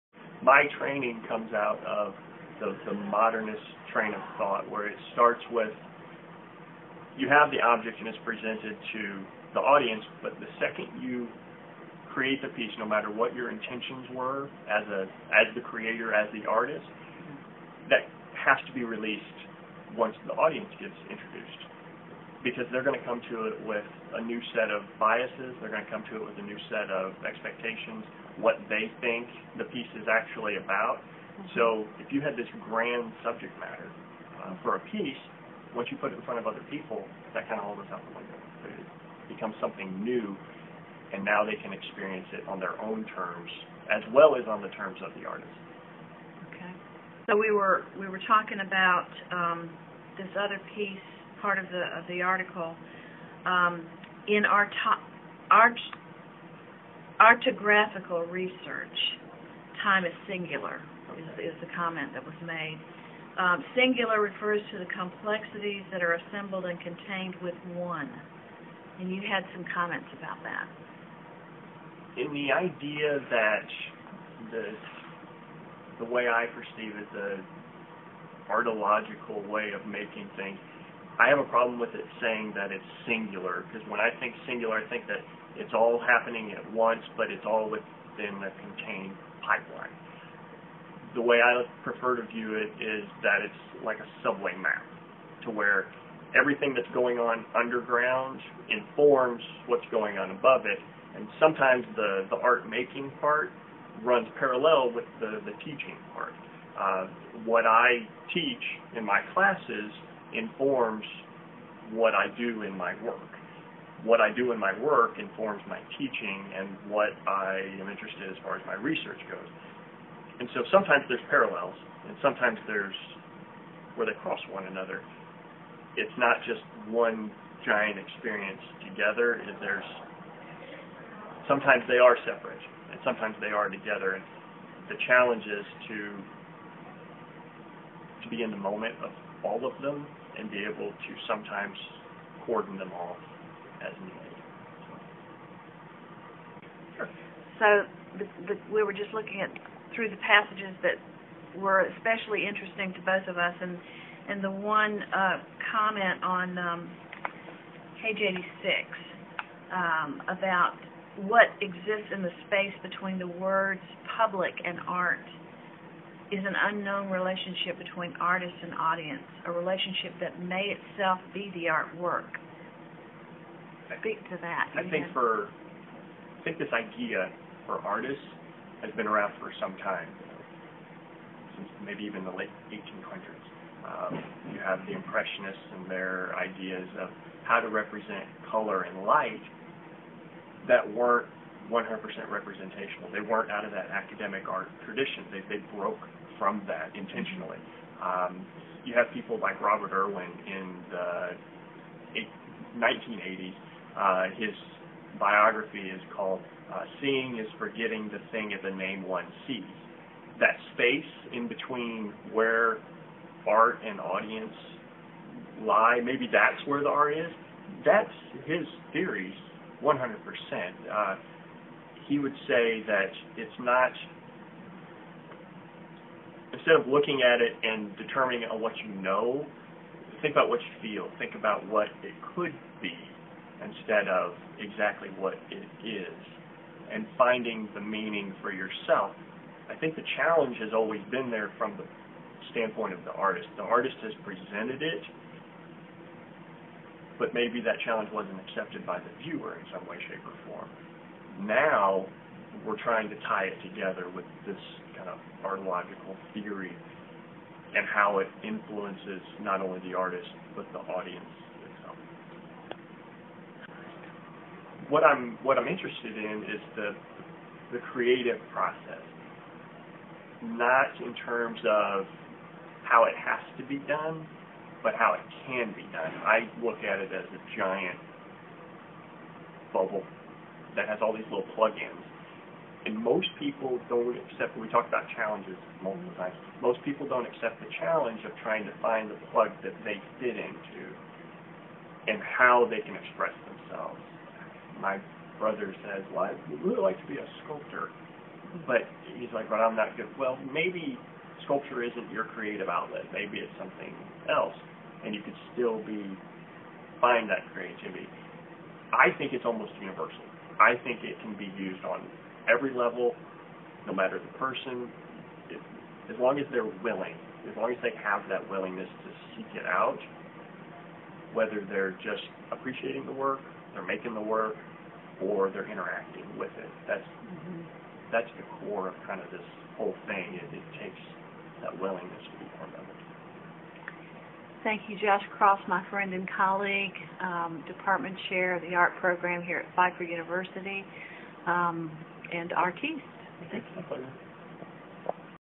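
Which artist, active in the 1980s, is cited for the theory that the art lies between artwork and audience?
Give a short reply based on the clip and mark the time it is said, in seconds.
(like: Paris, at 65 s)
Robert Irwin, at 199 s.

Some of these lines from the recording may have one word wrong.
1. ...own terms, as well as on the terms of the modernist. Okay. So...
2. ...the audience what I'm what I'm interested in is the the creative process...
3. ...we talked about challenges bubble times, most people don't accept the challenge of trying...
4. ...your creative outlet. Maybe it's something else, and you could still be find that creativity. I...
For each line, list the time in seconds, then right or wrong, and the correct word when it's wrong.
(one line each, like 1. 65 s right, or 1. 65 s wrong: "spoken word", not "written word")
1. 42 s wrong: "artist", not "modernist"
2. 260 s right
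3. 284 s wrong: "multiple", not "bubble"
4. 302 s right.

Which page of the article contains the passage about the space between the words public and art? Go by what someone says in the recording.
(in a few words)
86.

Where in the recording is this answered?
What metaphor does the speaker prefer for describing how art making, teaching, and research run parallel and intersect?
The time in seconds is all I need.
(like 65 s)
94 s.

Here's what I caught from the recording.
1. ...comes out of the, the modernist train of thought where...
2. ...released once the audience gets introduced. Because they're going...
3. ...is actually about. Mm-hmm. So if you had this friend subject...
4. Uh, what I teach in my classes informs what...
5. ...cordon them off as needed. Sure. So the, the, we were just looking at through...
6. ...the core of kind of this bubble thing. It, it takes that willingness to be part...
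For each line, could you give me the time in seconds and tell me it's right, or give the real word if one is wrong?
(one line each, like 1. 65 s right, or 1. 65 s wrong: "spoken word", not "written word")
1. 1 s right
2. 18 s right
3. 29 s wrong: "grand", not "friend"
4. 106 s right
5. 142 s right
6. 328 s wrong: "whole", not "bubble".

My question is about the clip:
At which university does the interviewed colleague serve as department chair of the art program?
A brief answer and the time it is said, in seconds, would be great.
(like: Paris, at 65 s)
Pfeiffer University, at 339 s.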